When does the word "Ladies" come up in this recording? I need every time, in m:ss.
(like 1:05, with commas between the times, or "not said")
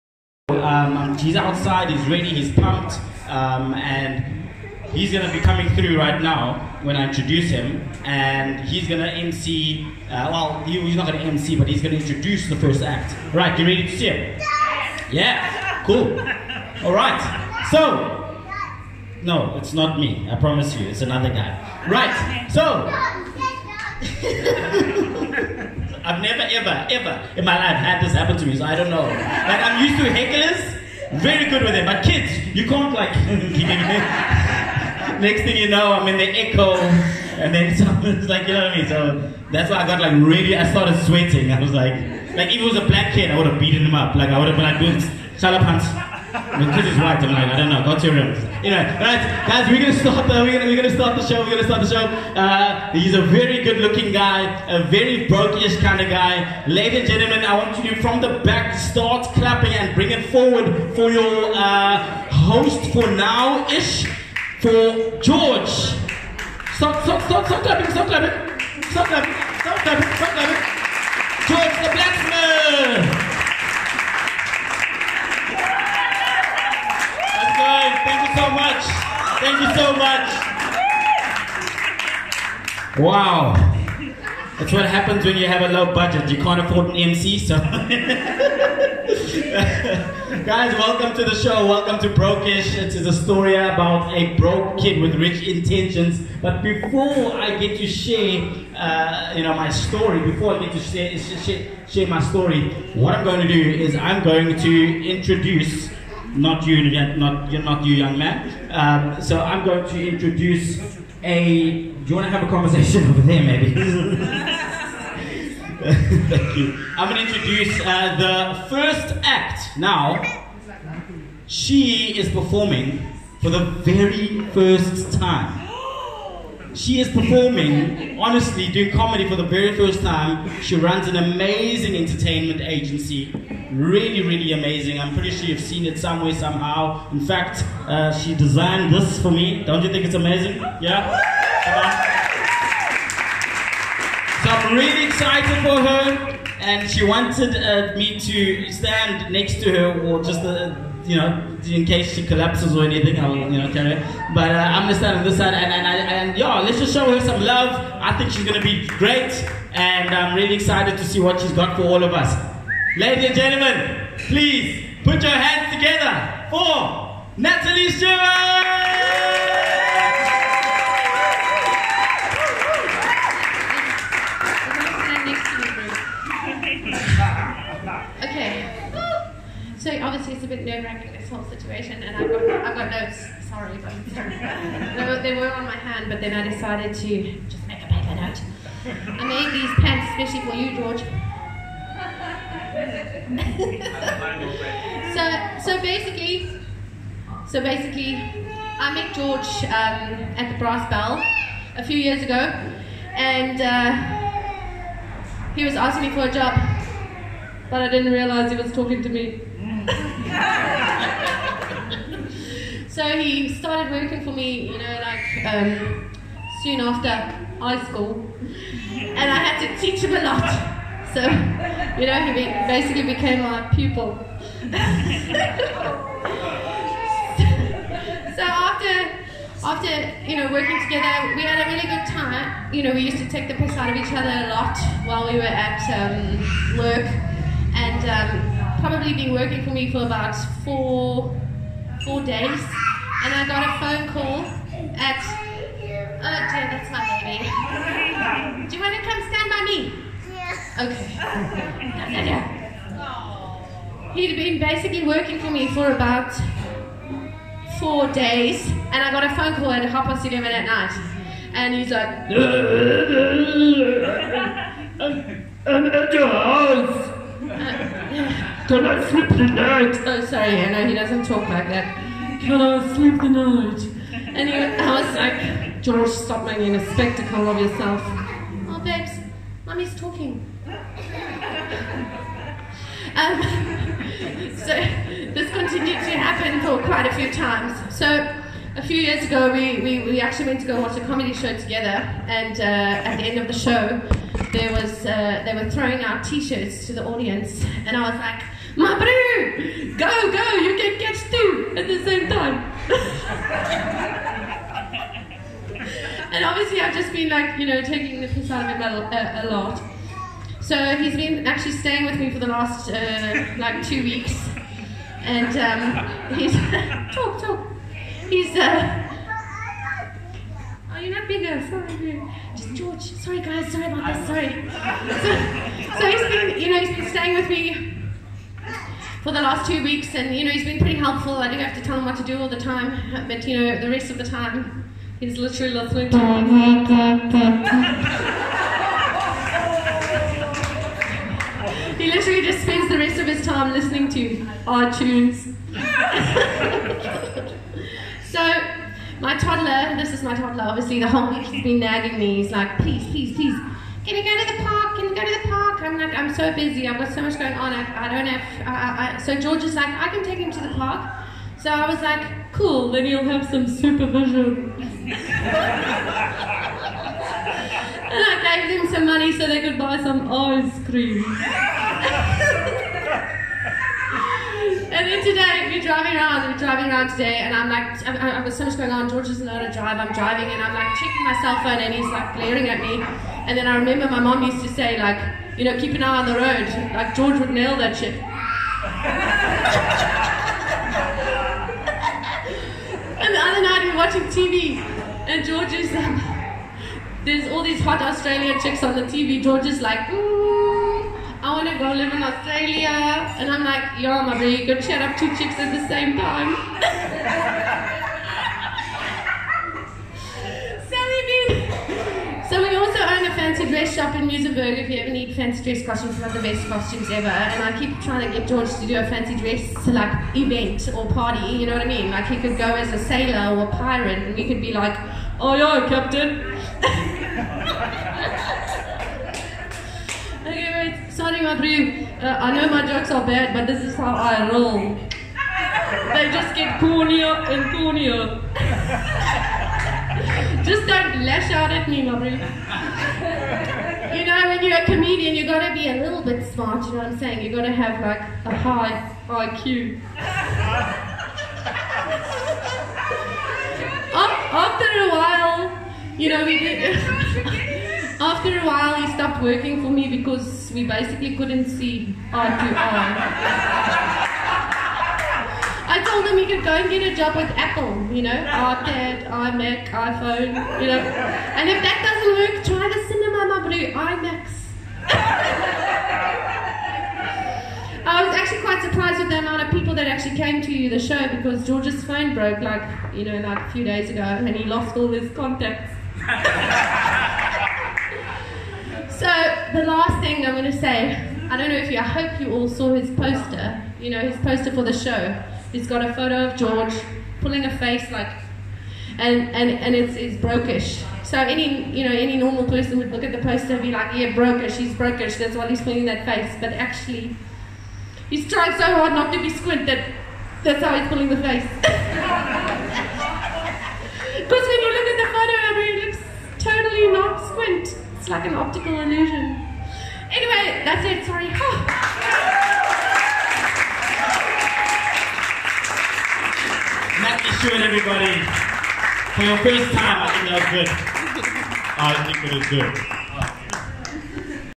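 0:56, 2:42.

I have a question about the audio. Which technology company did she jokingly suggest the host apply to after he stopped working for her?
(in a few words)
Apple.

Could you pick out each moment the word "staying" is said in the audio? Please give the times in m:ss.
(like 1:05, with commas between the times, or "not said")
5:11, 5:27.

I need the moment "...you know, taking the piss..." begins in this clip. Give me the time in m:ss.
5:07.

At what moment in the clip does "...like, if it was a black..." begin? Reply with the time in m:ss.
0:42.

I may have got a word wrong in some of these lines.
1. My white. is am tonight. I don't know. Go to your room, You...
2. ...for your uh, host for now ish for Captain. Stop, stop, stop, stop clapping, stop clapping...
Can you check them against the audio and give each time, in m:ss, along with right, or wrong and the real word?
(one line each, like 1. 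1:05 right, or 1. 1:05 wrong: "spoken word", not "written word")
1. 0:46 right
2. 1:00 wrong: "George", not "Captain".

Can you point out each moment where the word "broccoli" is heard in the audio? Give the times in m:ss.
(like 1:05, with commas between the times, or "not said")
not said.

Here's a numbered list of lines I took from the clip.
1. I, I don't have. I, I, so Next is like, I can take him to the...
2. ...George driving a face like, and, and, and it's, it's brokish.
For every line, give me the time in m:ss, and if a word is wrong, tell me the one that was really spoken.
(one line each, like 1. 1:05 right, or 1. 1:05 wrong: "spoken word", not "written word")
1. 5:57 wrong: "George", not "Next"
2. 8:16 wrong: "pulling", not "driving".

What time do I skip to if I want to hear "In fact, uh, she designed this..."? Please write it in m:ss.
2:17.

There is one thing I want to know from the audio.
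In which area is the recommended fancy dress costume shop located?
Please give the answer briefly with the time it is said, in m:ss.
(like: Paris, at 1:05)
Muizenberg, at 6:54.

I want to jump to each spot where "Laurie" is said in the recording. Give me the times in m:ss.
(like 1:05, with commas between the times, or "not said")
7:22.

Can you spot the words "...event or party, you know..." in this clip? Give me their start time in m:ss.
7:00.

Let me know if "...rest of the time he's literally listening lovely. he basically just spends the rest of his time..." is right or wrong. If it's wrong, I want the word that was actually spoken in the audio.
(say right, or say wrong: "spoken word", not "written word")
wrong: "literally", not "basically".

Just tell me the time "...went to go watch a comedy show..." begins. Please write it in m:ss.
4:50.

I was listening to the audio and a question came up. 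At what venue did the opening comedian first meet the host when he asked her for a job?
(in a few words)
the Brass Bell.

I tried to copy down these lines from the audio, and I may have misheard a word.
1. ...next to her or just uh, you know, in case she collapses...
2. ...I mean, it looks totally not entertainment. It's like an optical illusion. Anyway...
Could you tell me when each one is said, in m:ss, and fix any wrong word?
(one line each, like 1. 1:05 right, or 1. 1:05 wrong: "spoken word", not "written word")
1. 2:29 right
2. 8:35 wrong: "squint", not "entertainment".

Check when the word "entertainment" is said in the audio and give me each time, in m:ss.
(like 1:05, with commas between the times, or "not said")
2:11.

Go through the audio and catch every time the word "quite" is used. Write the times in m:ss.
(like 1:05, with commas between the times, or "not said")
4:46, 7:58.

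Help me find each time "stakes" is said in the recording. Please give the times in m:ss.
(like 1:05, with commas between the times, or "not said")
not said.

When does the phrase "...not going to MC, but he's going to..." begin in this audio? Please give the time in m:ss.
0:10.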